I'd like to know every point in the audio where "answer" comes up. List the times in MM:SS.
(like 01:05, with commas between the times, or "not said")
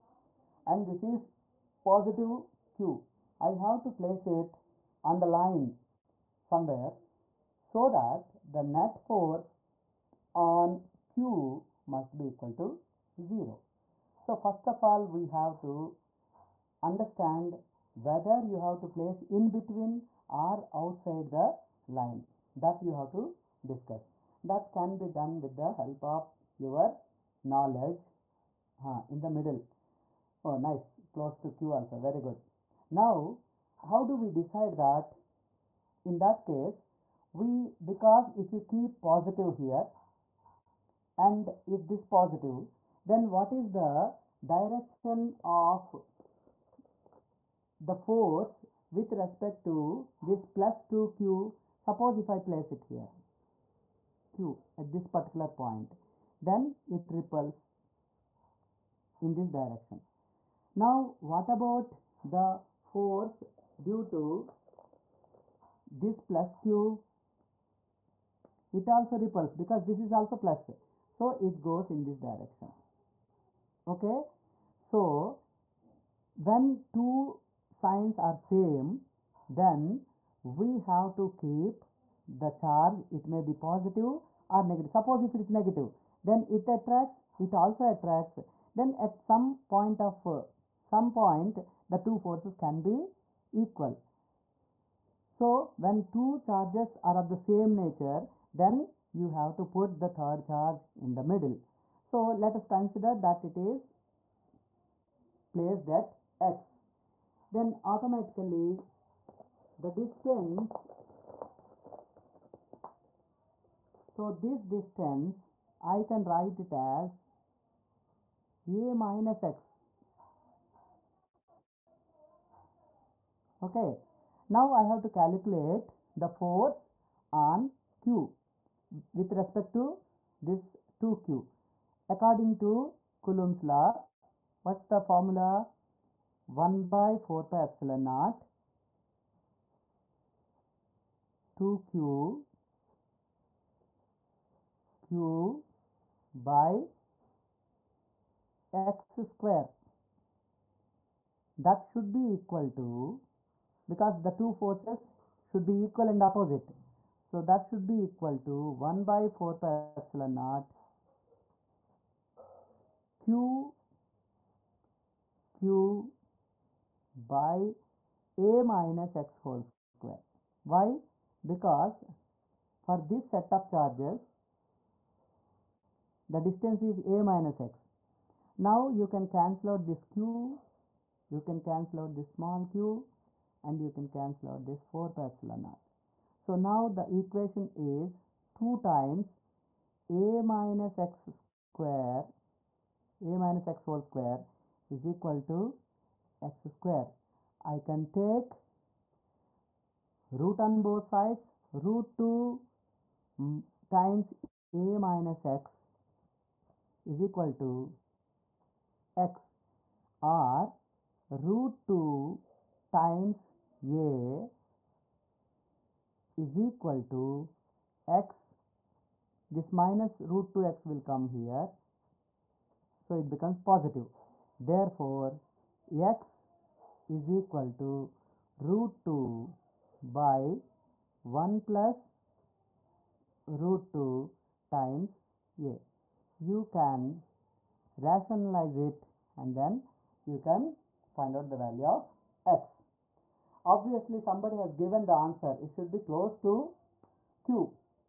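04:05.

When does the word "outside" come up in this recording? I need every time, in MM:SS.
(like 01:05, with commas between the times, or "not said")
00:20.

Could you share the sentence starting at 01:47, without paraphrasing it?
Then automatically the distance, so this distance I can write it as a minus x.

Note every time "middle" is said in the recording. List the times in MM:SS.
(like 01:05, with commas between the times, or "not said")
00:29, 01:41.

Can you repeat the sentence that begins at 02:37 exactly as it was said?
So that should be equal to 1 by 4 pi epsilon naught Q Q by A minus X whole square.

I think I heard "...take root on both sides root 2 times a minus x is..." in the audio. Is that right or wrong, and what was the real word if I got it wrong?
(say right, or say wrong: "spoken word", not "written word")
right.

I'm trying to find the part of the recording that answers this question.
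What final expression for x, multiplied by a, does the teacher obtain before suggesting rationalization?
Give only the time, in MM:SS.
03:48.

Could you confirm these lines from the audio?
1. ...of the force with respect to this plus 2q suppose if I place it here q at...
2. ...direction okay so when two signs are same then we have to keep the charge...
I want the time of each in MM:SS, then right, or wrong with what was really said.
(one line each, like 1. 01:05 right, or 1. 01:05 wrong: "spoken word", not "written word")
1. 00:45 right
2. 01:12 right.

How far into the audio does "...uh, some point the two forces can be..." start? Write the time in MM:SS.
01:30.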